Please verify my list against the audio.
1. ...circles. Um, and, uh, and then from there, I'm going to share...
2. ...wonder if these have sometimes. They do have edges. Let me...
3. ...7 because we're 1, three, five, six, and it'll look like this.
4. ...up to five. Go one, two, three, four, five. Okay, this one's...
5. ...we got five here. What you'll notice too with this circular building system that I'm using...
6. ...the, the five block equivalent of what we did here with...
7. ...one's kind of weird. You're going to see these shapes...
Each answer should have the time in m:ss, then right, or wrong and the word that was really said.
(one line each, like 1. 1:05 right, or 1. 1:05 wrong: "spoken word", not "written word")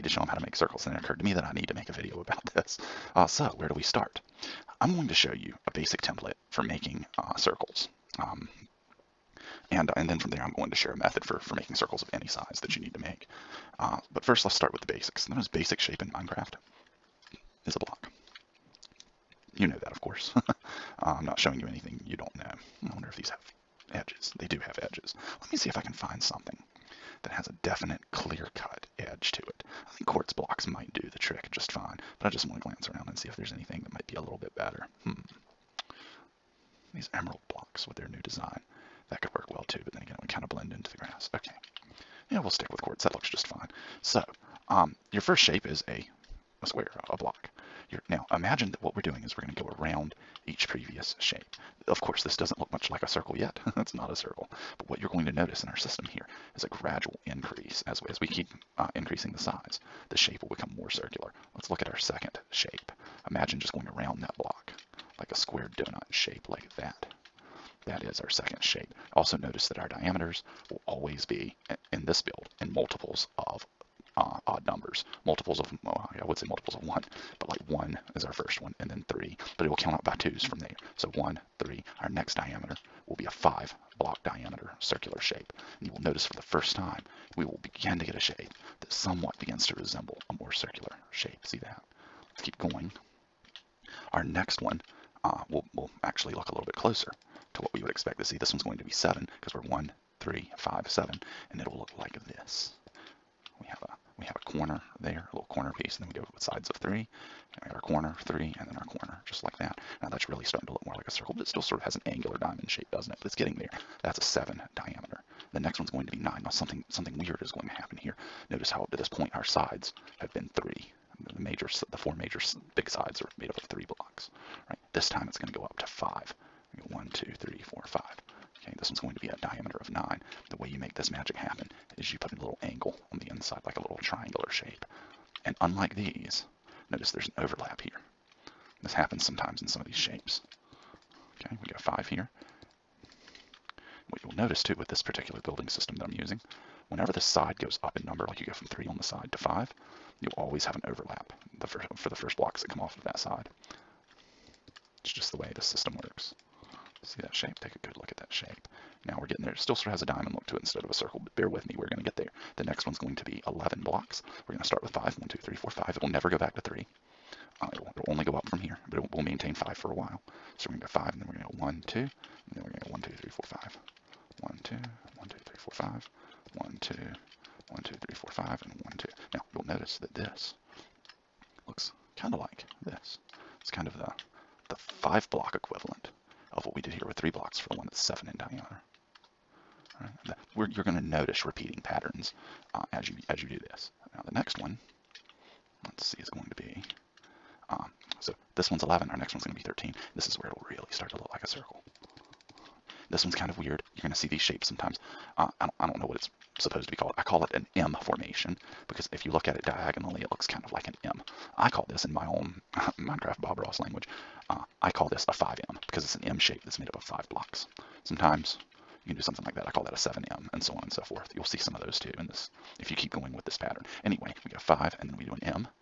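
1. 0:07 right
2. 0:22 wrong: "edges", not "sometimes"
3. 1:38 wrong: "seven", not "six"
4. 2:05 right
5. 2:21 wrong: "particular", not "circular"
6. 3:03 right
7. 3:23 right.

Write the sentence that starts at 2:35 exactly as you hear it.
It's just the way the system works.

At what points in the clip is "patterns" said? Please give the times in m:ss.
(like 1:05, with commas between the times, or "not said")
3:11, 3:43.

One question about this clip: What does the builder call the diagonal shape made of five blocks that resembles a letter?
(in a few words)
5M.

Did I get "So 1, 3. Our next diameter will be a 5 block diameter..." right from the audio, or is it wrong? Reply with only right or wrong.
right.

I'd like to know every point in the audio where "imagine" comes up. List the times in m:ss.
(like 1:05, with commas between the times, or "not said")
0:48, 1:03.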